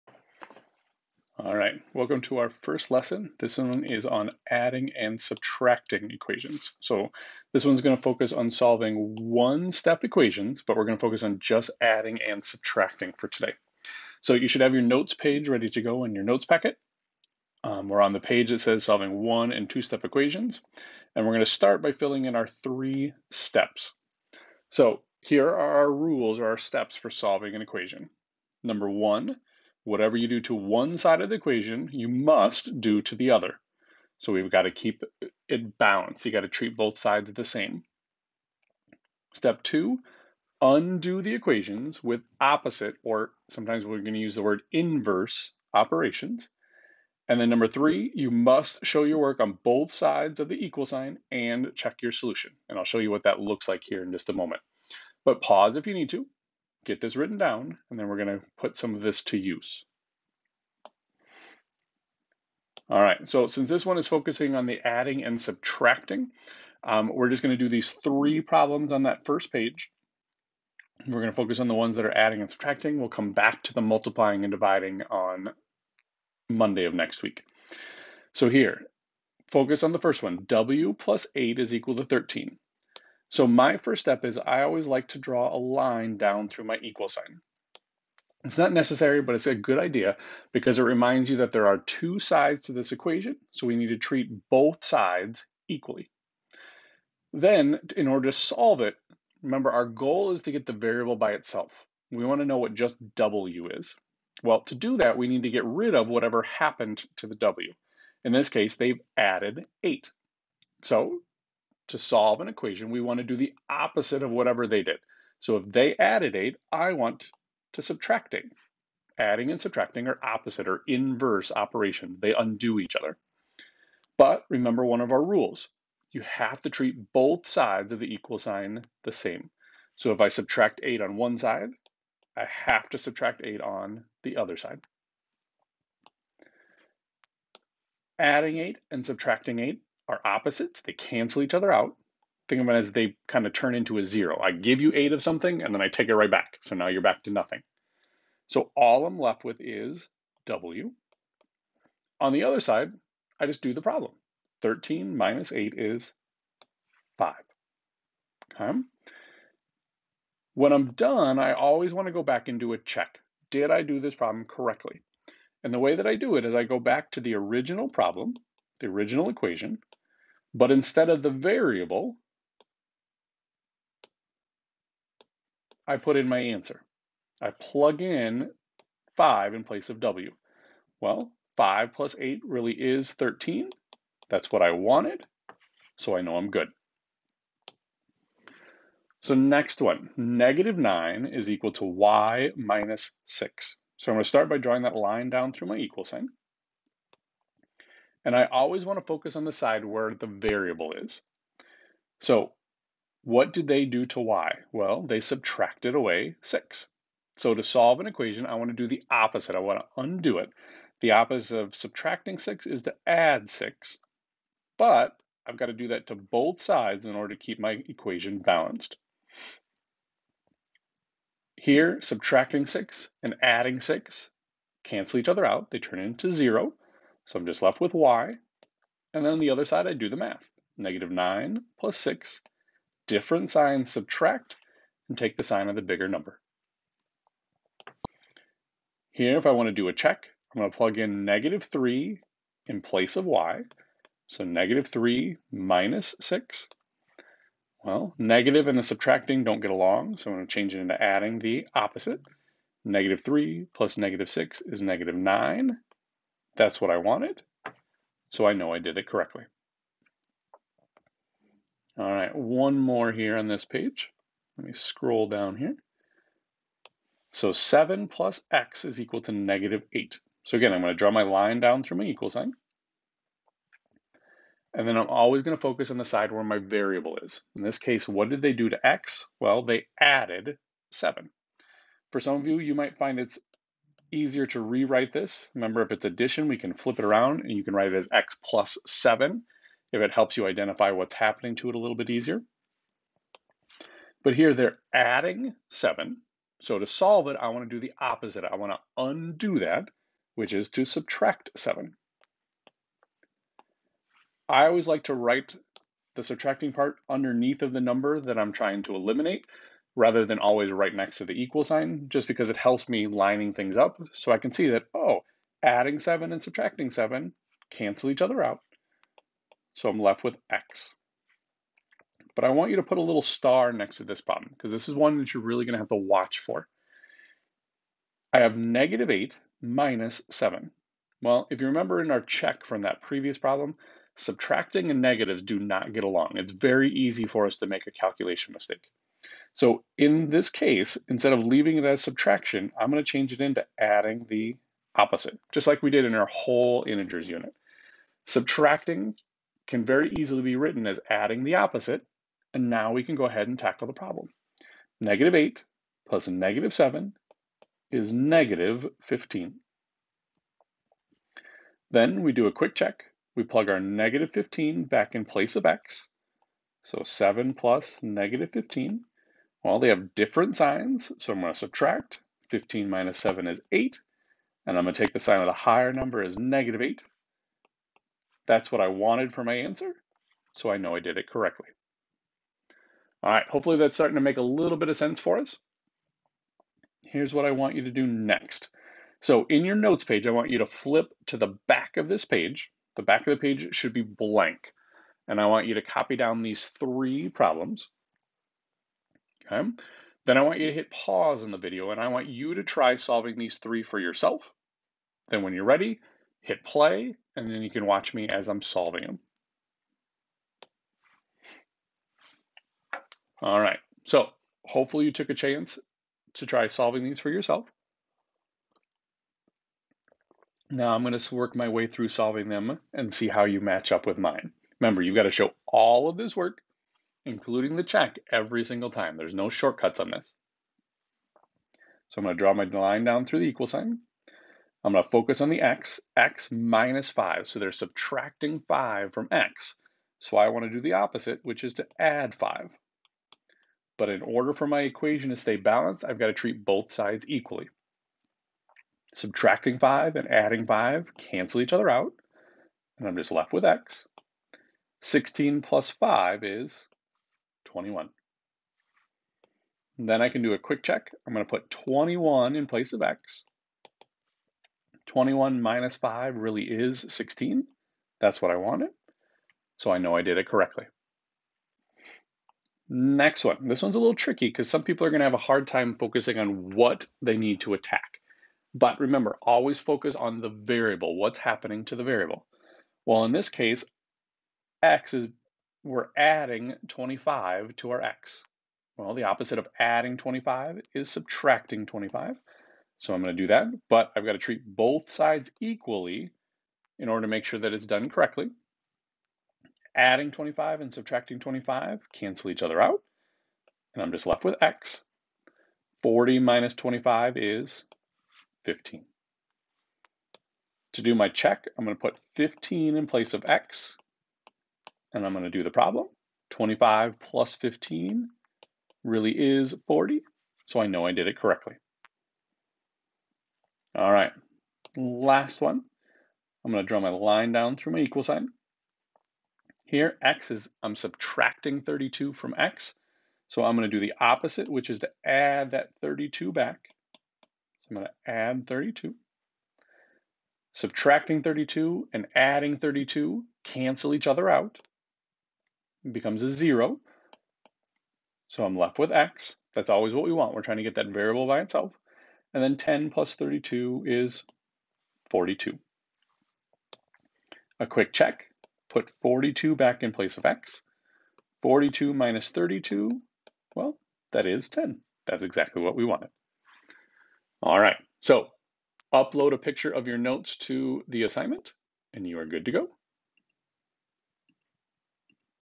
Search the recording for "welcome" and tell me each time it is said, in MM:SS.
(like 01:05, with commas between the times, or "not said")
00:01.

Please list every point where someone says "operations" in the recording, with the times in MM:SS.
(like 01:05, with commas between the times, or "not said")
00:45, 02:01.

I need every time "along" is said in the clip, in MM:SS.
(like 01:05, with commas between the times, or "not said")
04:09, 05:36.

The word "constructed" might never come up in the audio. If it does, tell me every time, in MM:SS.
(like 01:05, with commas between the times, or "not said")
not said.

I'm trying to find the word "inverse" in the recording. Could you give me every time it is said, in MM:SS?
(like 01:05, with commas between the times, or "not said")
00:44, 02:00.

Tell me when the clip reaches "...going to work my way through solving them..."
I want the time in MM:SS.
07:01.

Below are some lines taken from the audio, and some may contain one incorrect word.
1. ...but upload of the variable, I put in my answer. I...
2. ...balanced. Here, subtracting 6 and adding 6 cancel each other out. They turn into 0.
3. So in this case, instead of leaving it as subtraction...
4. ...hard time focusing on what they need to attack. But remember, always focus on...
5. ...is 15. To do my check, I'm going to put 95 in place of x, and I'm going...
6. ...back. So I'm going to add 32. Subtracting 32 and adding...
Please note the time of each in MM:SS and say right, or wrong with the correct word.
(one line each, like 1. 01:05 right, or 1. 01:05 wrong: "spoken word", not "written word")
1. 02:50 wrong: "instead", not "upload"
2. 03:38 right
3. 05:39 right
4. 07:55 right
5. 08:27 wrong: "15", not "95"
6. 08:56 right.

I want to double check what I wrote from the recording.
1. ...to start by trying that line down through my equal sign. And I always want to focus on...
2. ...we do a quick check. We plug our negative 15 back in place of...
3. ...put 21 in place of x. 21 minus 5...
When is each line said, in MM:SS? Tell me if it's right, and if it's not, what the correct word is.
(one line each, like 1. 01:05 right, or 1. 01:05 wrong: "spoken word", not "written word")
1. 03:14 wrong: "drawing", not "trying"
2. 06:02 right
3. 07:41 right.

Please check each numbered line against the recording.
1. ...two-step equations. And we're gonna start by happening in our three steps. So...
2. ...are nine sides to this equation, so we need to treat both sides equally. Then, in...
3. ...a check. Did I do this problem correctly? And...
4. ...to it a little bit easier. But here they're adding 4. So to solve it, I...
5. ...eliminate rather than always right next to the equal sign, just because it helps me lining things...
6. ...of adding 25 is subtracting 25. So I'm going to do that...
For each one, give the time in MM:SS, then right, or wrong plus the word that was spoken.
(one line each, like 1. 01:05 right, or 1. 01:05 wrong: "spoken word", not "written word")
1. 00:19 wrong: "filling", not "happening"
2. 01:31 wrong: "two", not "nine"
3. 02:42 right
4. 04:51 wrong: "7", not "4"
5. 05:08 right
6. 08:09 right.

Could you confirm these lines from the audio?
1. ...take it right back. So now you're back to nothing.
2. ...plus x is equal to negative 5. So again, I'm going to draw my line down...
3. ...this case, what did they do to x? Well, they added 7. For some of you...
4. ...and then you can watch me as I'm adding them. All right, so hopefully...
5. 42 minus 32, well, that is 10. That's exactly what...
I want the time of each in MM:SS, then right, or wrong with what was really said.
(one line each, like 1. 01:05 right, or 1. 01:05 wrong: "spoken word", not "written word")
1. 02:25 right
2. 04:28 wrong: "8", not "5"
3. 04:37 right
4. 06:47 wrong: "solving", not "adding"
5. 09:21 right.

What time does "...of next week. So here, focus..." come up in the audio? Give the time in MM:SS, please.
01:16.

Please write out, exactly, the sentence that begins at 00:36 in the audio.
You got to treat both sides the same.